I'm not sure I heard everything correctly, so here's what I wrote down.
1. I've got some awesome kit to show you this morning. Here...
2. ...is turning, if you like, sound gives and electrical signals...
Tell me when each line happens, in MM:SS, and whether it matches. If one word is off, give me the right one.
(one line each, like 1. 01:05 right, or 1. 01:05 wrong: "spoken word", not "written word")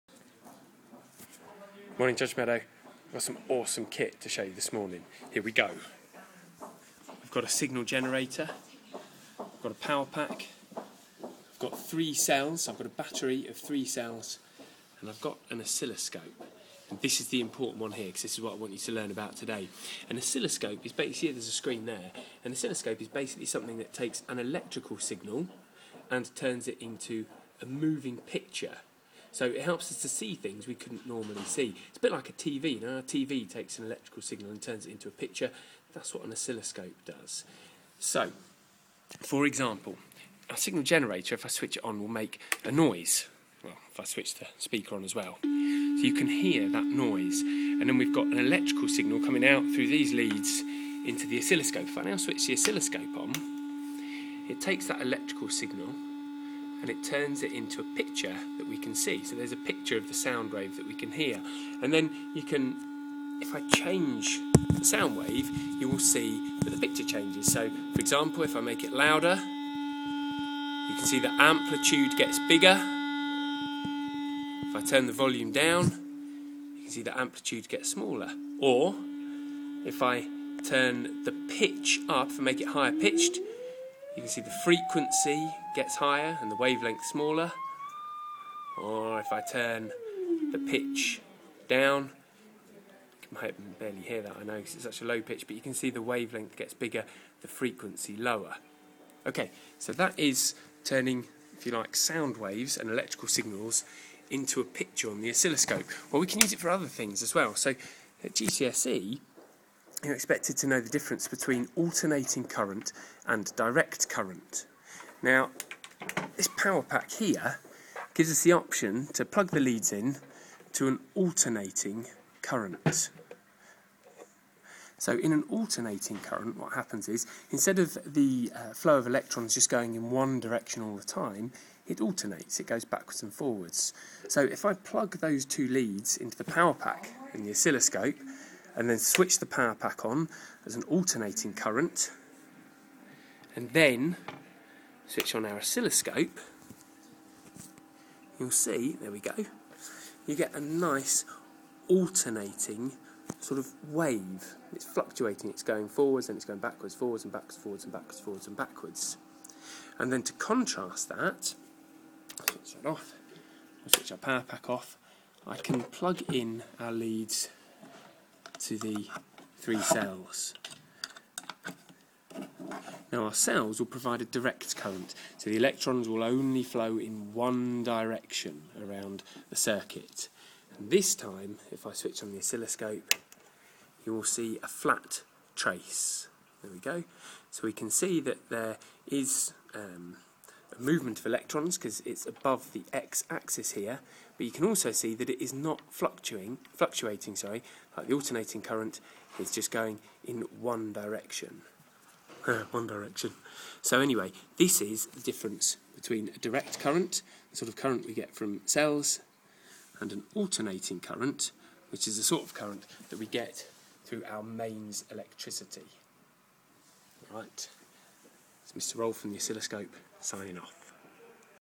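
1. 00:02 right
2. 01:40 wrong: "waves", not "gives".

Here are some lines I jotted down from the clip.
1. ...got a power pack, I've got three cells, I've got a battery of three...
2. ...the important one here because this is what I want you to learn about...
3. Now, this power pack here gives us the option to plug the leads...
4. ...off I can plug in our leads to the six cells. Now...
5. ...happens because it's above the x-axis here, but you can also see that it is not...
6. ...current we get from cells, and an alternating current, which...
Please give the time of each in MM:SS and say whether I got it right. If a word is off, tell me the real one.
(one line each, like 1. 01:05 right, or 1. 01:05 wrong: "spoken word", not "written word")
1. 00:09 right
2. 00:17 right
3. 01:55 right
4. 02:44 wrong: "three", not "six"
5. 03:11 wrong: "electrons", not "happens"
6. 03:27 right.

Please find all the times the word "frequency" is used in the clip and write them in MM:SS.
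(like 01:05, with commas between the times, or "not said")
01:24, 01:37.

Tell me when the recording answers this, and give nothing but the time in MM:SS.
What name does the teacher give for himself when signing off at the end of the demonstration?
03:38.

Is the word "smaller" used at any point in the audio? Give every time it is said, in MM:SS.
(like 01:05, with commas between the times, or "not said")
01:17, 01:27.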